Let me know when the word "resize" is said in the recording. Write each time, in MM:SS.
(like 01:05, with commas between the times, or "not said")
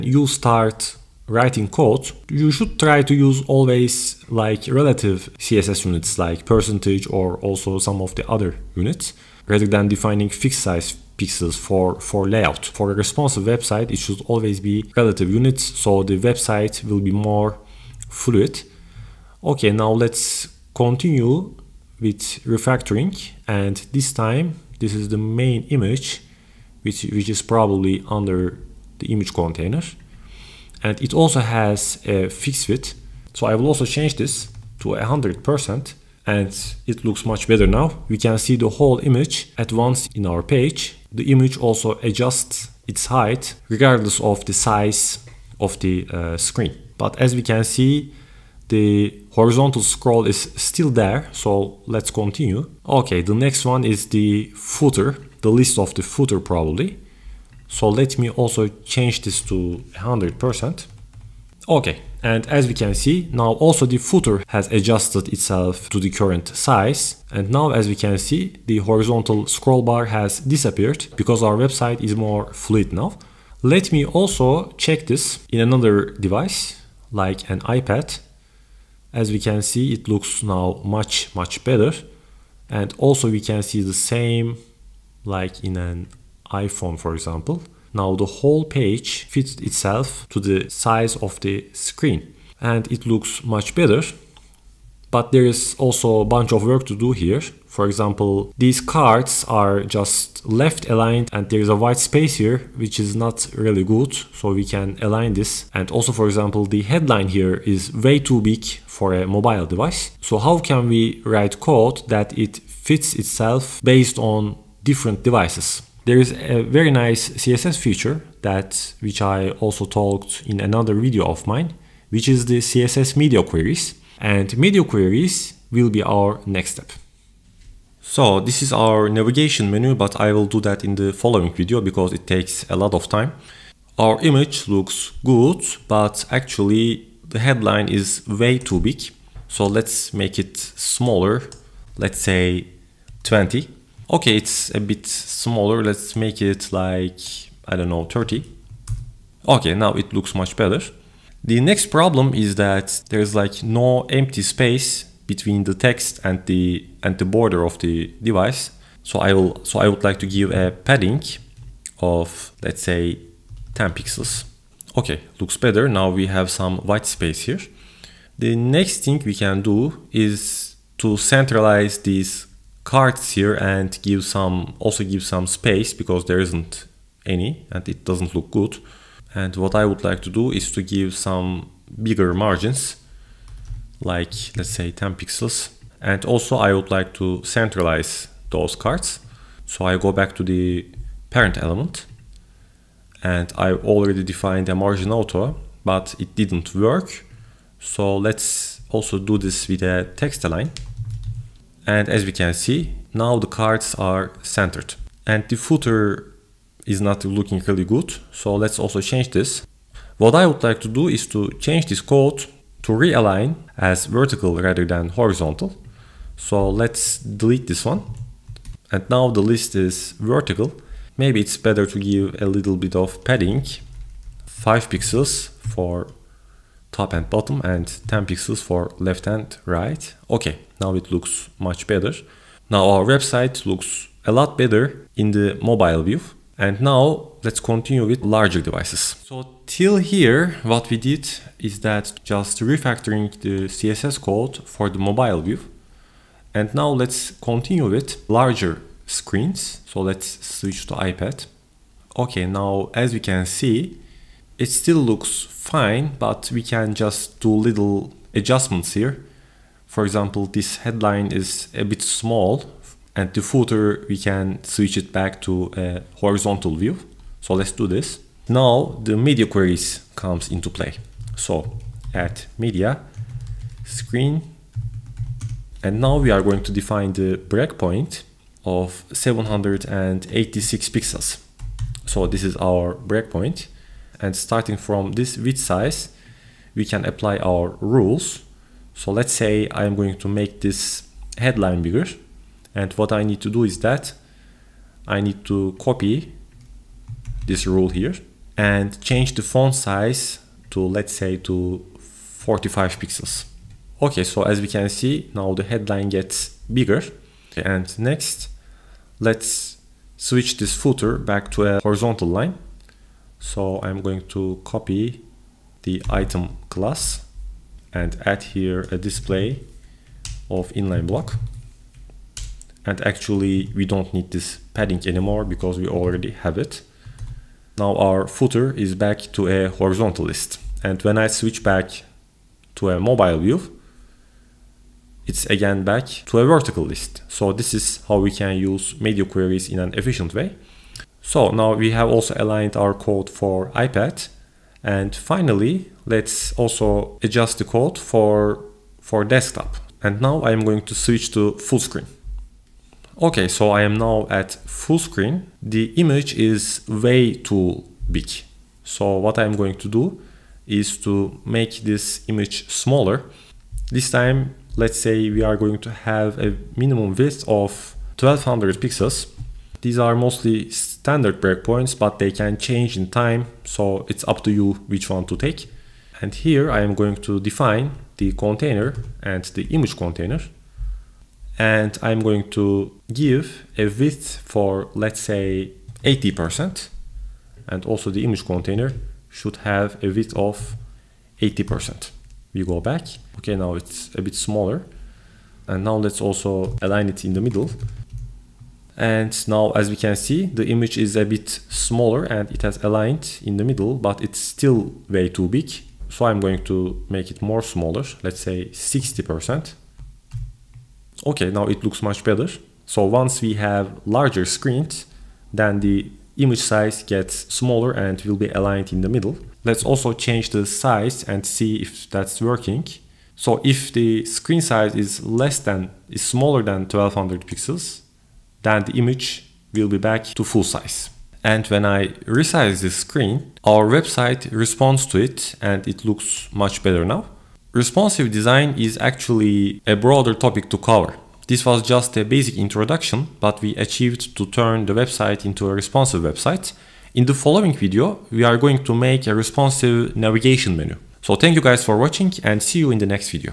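07:12.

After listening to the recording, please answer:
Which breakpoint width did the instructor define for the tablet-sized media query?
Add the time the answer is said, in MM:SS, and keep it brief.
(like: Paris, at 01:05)
786 pixels, at 04:39.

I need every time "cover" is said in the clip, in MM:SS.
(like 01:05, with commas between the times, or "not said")
07:20.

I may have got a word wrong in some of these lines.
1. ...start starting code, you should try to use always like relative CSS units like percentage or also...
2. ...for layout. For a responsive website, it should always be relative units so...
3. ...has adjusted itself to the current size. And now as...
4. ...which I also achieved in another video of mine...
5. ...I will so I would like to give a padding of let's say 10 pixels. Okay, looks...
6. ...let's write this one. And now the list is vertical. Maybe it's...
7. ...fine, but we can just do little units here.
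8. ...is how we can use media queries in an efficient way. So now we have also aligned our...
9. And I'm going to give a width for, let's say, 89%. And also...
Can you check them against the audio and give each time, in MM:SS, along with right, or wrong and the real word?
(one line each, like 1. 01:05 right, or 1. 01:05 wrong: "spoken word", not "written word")
1. 00:00 wrong: "writing", not "starting"
2. 00:12 right
3. 01:04 right
4. 01:59 wrong: "talked", not "achieved"
5. 02:39 right
6. 03:36 wrong: "delete", not "write"
7. 04:15 wrong: "adjustments", not "units"
8. 05:37 right
9. 06:21 wrong: "80", not "89".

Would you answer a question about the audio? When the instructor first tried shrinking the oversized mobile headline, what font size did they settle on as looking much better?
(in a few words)
30.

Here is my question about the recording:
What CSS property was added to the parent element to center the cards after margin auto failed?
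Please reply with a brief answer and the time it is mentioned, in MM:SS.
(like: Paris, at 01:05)
text align, at 03:20.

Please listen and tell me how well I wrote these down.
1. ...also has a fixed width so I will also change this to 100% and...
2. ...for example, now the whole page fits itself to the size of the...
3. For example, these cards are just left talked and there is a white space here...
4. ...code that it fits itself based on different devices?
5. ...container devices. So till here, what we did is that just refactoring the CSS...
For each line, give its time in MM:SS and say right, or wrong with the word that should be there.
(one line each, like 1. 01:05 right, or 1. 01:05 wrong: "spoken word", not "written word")
1. 00:31 right
2. 01:26 right
3. 01:37 wrong: "aligned", not "talked"
4. 01:51 right
5. 03:58 wrong: "larger", not "container".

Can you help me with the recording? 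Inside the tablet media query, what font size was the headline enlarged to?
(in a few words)
45 pixels.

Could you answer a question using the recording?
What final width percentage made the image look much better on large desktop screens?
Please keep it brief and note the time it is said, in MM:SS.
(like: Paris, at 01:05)
60%, at 06:48.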